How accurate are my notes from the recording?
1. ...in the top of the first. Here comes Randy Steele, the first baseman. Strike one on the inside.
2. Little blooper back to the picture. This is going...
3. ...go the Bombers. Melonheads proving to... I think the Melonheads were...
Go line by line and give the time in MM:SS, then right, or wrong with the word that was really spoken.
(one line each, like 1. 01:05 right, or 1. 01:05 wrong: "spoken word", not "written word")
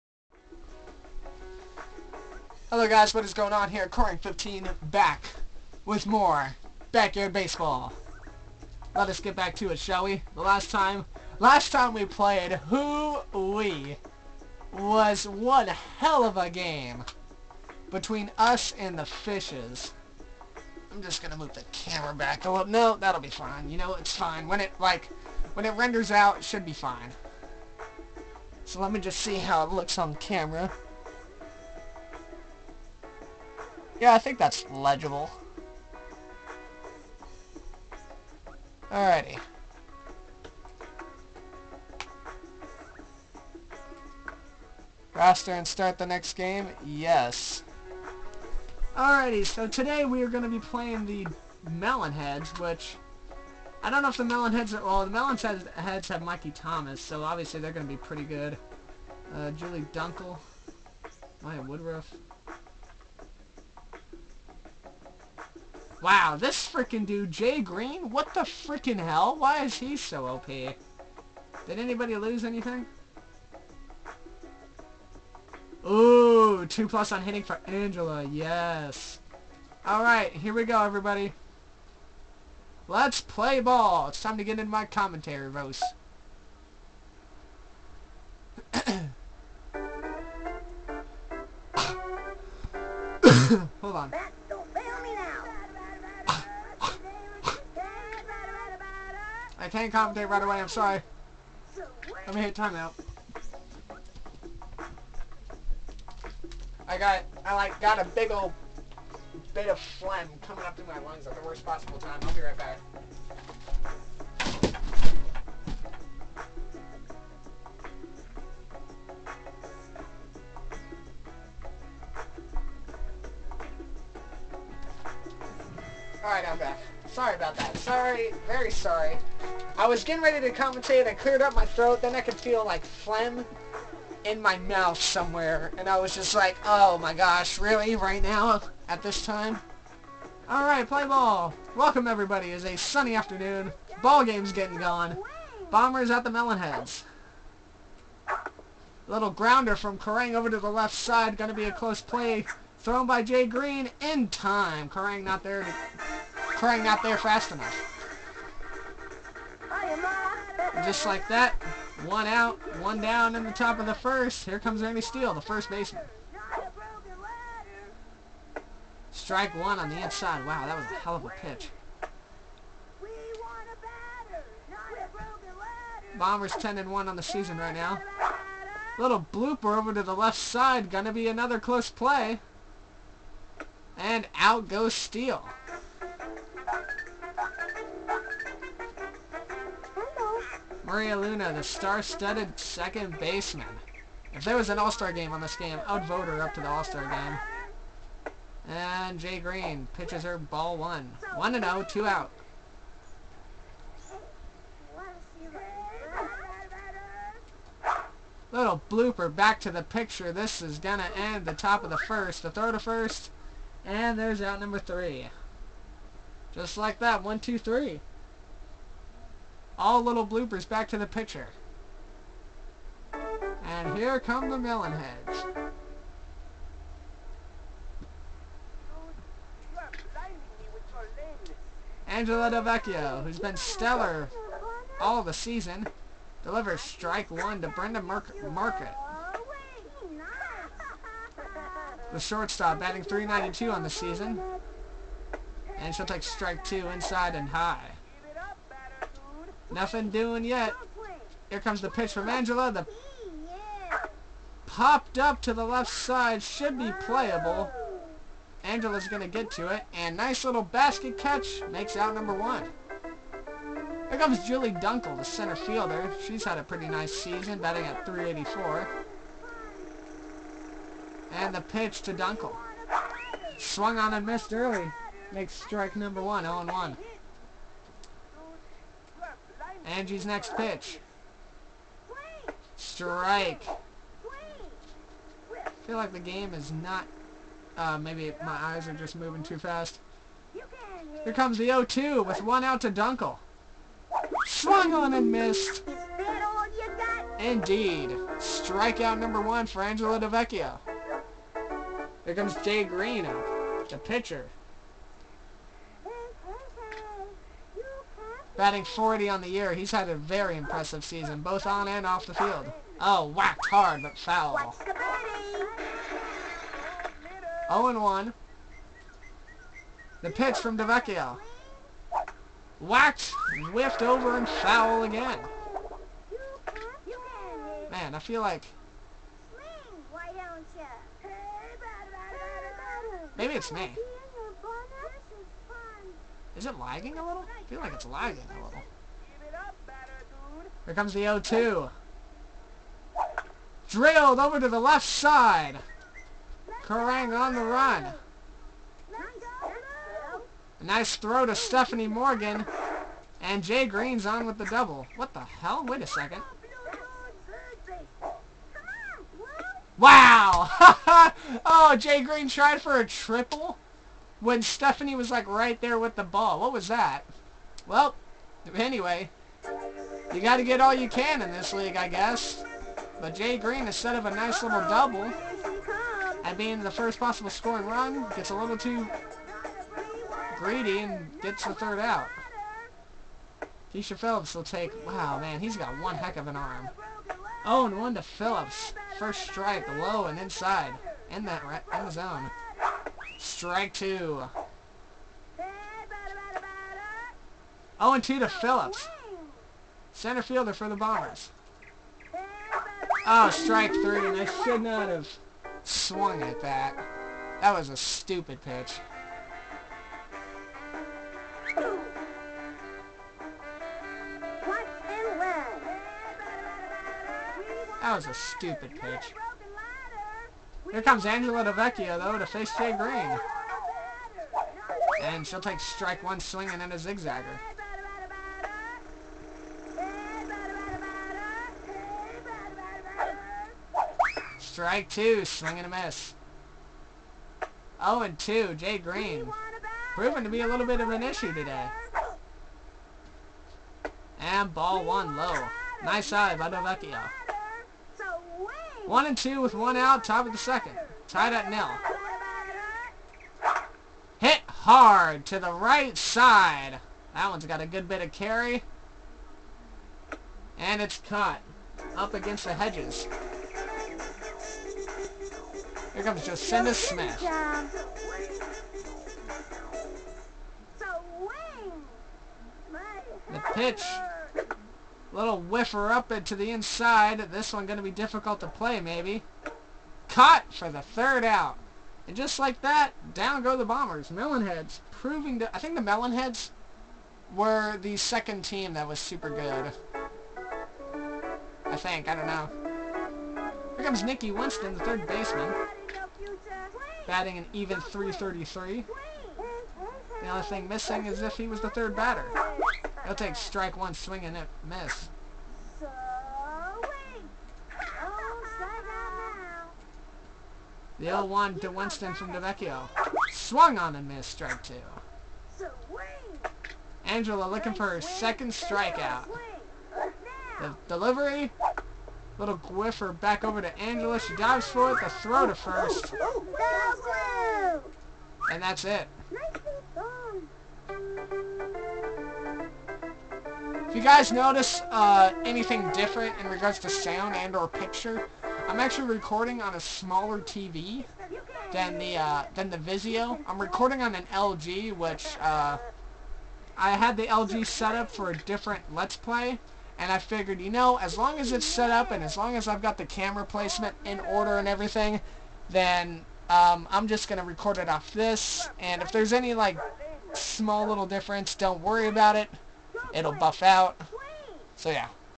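1. 02:43 right
2. 03:28 right
3. 08:03 right.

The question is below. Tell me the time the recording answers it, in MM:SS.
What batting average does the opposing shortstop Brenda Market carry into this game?
04:03.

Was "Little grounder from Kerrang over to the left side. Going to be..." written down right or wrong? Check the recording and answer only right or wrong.
right.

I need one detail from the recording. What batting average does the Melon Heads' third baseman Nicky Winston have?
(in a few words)
.333.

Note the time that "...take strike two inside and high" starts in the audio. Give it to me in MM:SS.
04:06.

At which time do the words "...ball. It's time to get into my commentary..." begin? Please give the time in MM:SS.
01:23.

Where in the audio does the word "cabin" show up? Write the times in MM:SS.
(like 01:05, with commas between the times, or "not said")
not said.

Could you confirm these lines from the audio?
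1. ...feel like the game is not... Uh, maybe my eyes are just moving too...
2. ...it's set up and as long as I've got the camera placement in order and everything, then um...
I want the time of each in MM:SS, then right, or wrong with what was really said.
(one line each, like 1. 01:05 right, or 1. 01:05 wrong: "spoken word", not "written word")
1. 04:45 right
2. 09:11 right.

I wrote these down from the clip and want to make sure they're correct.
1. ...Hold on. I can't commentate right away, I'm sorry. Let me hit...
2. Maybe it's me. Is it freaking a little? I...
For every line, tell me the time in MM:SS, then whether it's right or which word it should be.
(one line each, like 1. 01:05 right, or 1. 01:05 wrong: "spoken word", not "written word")
1. 01:33 right
2. 05:33 wrong: "lagging", not "freaking".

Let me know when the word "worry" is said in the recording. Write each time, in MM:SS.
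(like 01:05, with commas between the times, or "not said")
09:22.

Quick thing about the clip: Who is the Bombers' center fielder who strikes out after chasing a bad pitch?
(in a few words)
Keisha Phillips.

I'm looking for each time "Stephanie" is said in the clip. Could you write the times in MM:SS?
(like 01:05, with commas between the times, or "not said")
05:51, 06:04.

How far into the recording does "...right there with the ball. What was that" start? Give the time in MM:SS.
06:05.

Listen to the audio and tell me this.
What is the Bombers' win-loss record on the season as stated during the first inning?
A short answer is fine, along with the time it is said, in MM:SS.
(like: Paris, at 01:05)
10 and 1, at 02:56.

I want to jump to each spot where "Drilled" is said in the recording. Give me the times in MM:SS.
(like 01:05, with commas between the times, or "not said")
05:43.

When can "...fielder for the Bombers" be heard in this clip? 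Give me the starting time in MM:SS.
06:40.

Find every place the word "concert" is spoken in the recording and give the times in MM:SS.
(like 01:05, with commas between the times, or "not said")
not said.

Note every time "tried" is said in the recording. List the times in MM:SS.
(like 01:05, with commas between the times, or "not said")
06:02.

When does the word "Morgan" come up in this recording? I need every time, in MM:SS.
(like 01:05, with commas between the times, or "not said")
05:52.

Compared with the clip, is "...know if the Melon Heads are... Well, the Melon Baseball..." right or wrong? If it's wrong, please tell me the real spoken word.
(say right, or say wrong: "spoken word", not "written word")
wrong: "Heads", not "Baseball".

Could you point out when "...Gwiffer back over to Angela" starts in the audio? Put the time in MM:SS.
08:42.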